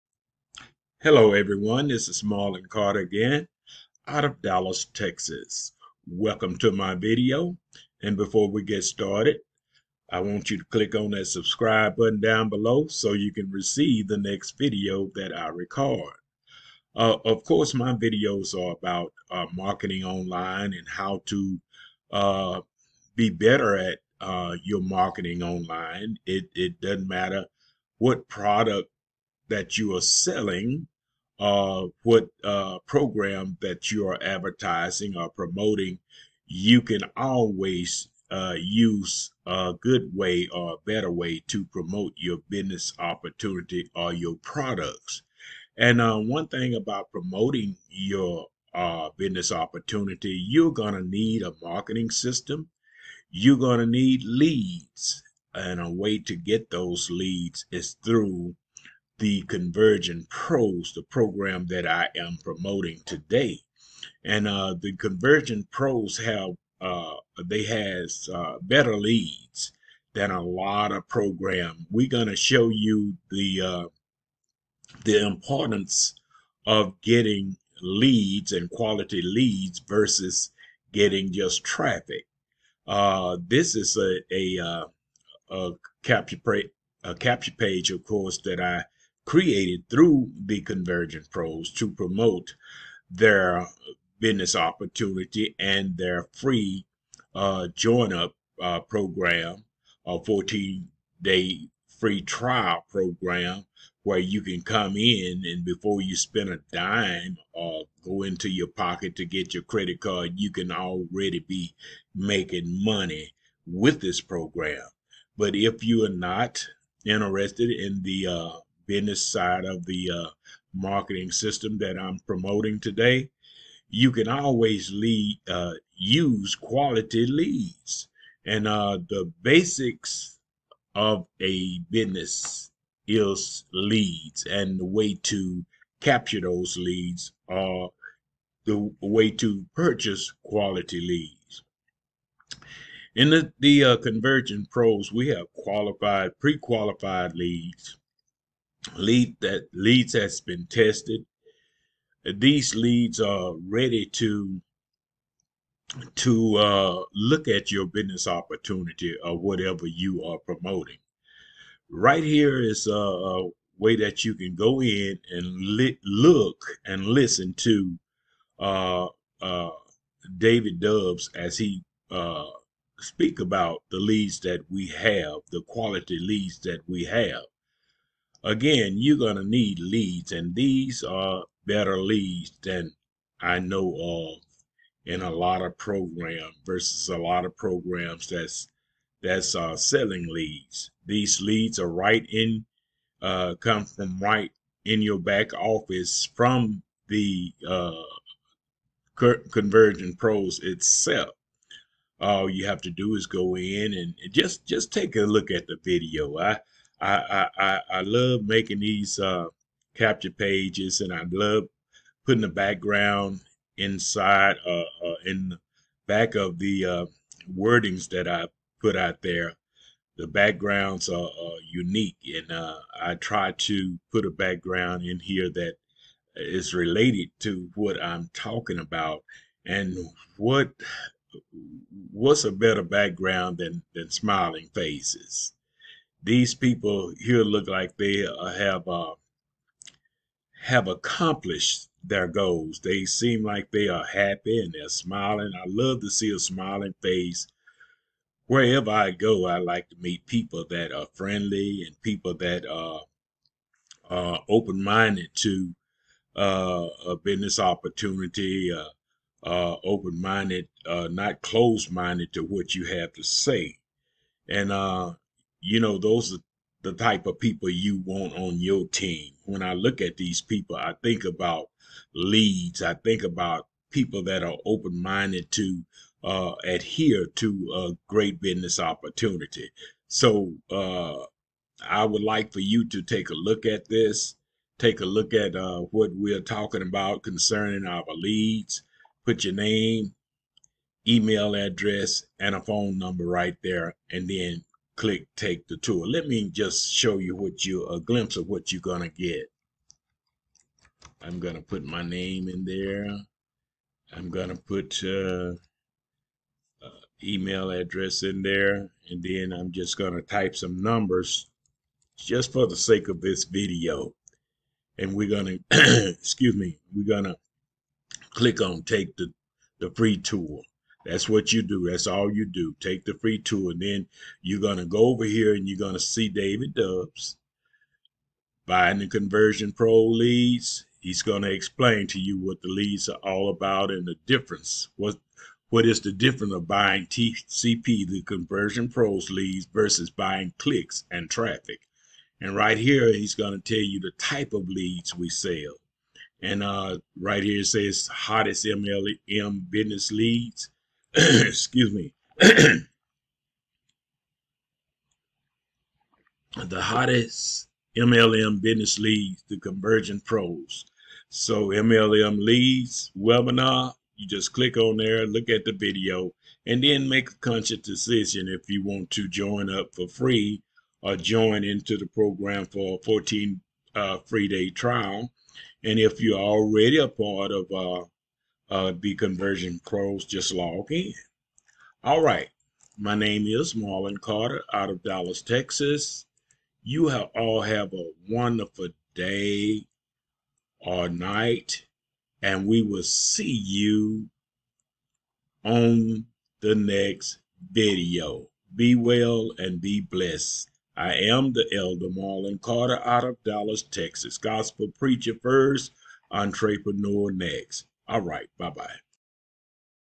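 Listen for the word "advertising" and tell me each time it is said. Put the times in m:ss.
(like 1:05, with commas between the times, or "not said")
0:34.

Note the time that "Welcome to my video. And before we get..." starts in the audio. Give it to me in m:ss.
0:06.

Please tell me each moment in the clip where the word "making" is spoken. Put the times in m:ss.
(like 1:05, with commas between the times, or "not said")
1:52, 3:28.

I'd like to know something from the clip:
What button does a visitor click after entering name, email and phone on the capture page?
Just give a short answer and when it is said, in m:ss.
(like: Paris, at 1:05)
take the tour, at 4:55.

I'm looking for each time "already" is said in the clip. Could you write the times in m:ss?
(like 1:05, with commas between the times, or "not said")
1:50, 6:16.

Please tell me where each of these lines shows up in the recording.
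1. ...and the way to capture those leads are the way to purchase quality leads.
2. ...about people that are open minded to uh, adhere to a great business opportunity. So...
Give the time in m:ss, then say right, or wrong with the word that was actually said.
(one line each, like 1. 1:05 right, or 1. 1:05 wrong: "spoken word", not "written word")
1. 2:14 right
2. 4:33 right.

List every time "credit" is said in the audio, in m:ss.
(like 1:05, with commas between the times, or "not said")
1:49.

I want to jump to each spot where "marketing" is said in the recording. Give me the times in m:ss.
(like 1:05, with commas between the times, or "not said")
0:19, 0:24, 0:51, 2:00.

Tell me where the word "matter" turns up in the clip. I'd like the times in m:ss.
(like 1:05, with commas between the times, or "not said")
0:27.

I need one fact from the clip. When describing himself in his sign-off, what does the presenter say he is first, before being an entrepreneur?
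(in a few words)
Gospel preacher.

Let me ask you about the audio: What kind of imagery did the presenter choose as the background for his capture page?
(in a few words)
smiling faces.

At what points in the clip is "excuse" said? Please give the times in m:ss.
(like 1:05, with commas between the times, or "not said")
5:16, 5:51.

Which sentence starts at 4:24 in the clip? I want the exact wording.
And uh, you know, those are the type of people you want on your team.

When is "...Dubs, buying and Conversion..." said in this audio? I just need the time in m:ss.
5:26.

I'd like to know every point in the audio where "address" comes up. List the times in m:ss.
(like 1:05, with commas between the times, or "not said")
4:51, 5:07.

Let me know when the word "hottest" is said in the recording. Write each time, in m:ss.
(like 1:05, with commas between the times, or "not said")
5:48, 5:56.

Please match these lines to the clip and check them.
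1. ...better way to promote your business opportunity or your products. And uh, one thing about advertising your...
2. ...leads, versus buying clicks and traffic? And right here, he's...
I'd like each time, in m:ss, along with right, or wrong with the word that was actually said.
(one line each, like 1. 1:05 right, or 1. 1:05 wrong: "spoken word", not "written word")
1. 0:40 wrong: "promoting", not "advertising"
2. 5:39 right.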